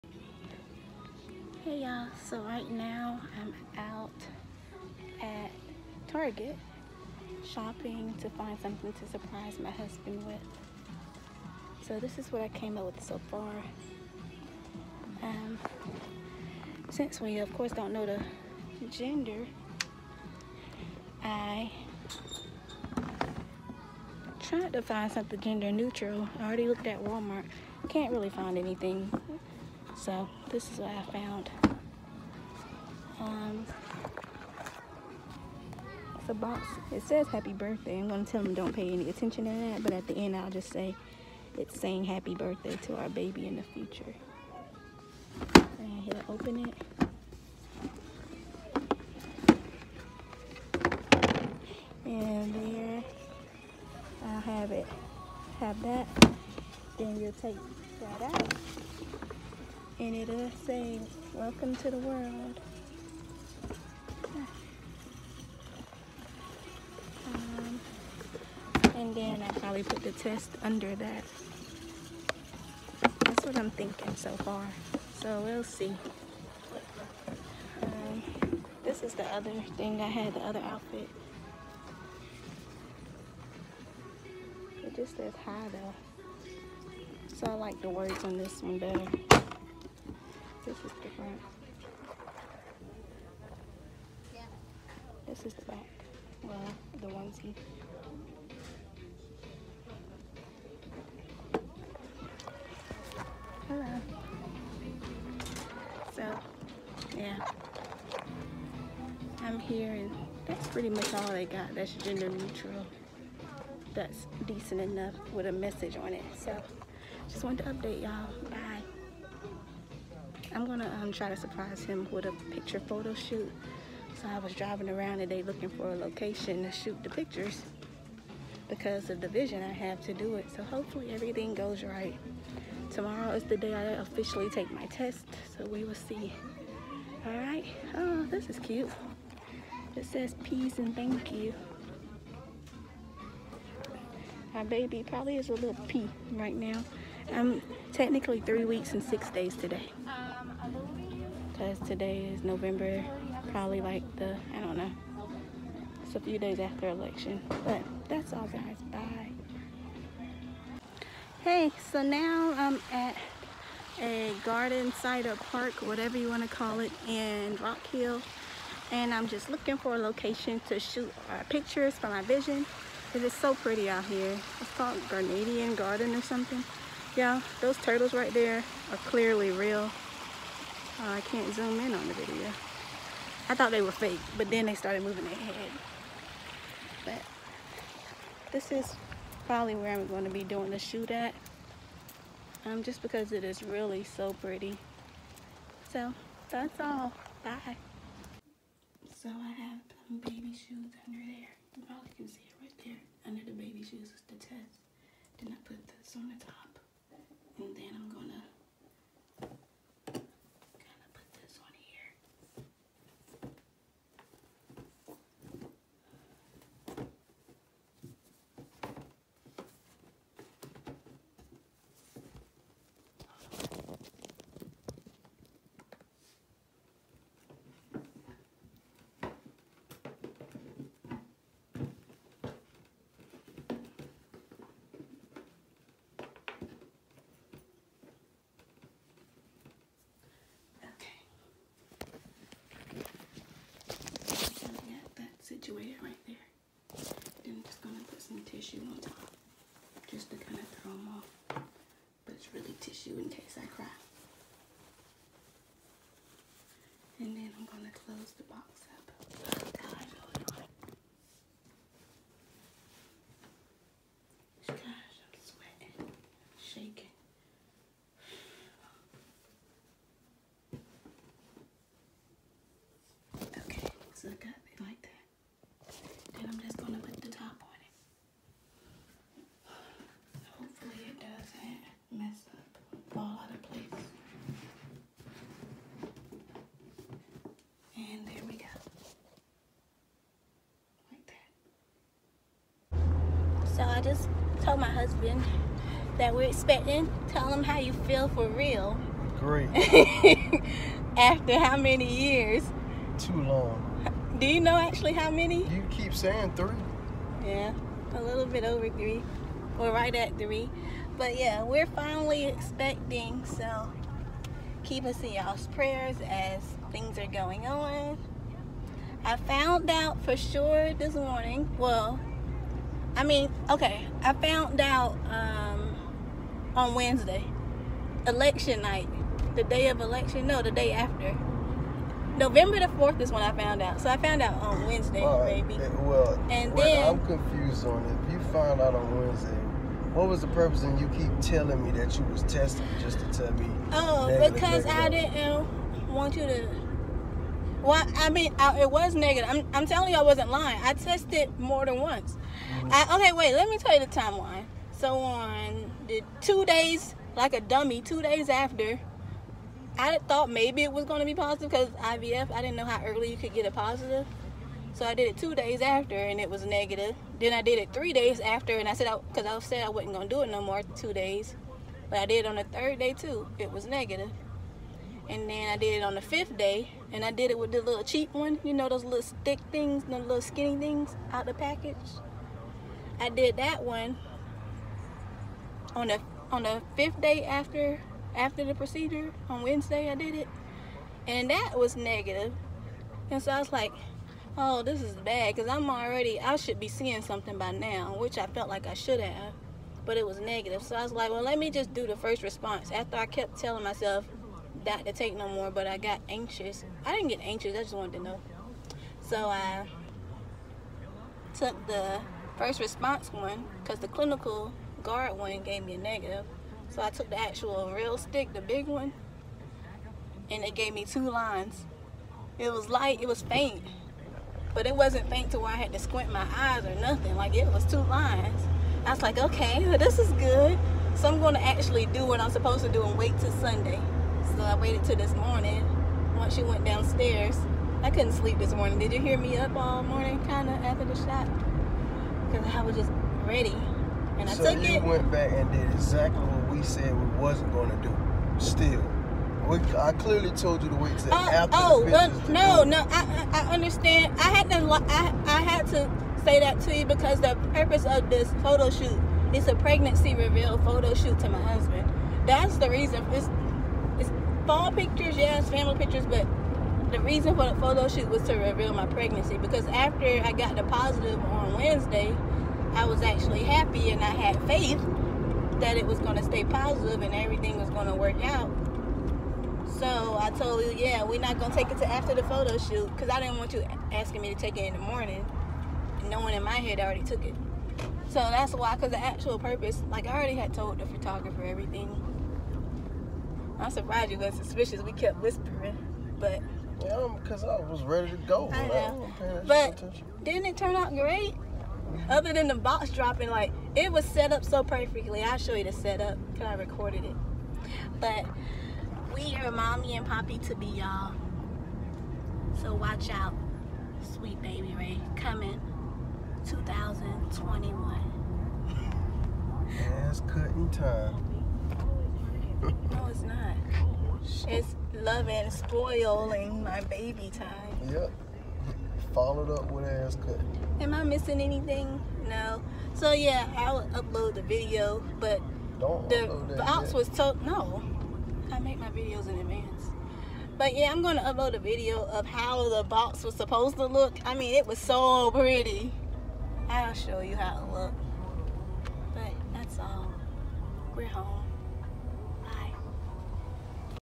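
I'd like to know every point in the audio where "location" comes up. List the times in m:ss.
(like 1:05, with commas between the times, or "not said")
2:05, 2:49.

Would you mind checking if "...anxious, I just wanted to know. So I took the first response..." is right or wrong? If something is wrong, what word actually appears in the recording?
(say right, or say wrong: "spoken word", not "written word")
right.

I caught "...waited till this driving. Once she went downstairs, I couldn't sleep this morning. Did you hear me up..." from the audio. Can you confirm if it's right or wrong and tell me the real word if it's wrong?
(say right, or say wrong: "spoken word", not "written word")
wrong: "morning", not "driving".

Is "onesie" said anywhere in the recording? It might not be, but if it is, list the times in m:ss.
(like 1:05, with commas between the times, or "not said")
1:37.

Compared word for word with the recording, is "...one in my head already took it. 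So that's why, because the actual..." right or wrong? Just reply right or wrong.
right.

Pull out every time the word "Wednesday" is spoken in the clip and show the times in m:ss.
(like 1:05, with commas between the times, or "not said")
5:26, 5:34, 5:39, 6:29, 7:51.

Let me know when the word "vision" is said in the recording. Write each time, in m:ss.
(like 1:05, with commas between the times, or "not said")
2:09, 2:52.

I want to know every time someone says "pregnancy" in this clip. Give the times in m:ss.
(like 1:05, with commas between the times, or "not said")
7:39, 7:49.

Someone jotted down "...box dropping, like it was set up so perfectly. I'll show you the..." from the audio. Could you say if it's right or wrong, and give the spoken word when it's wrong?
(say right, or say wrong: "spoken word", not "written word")
right.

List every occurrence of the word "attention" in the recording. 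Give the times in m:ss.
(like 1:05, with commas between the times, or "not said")
0:39, 8:19.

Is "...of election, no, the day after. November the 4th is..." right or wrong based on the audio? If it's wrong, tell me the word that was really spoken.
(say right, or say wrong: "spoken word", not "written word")
right.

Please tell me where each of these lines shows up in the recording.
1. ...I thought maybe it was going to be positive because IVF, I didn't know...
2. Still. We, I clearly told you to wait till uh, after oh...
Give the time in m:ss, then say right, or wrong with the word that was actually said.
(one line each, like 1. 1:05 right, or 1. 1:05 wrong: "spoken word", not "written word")
1. 5:59 right
2. 7:28 right.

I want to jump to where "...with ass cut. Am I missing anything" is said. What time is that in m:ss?
8:49.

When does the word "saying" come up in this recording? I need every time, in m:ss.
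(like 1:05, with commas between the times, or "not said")
0:41, 5:06.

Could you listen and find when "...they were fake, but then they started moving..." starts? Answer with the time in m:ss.
3:03.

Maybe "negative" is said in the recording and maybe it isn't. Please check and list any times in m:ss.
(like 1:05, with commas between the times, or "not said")
5:49, 6:06, 6:13, 6:31, 6:40, 6:55.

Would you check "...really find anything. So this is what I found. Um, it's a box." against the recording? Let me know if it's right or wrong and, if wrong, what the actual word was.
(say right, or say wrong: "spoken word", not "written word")
right.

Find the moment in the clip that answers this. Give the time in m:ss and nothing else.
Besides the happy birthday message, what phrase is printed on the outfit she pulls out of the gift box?
1:01.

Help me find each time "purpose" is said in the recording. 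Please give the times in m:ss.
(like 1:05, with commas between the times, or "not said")
5:40, 7:37, 8:09.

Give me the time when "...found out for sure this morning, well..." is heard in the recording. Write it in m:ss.
5:19.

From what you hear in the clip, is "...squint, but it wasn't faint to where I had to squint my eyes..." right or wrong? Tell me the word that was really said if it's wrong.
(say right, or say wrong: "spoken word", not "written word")
wrong: "faint", not "squint".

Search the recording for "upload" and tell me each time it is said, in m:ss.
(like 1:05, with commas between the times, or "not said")
8:54, 9:01.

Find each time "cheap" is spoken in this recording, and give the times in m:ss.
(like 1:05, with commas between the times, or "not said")
6:18.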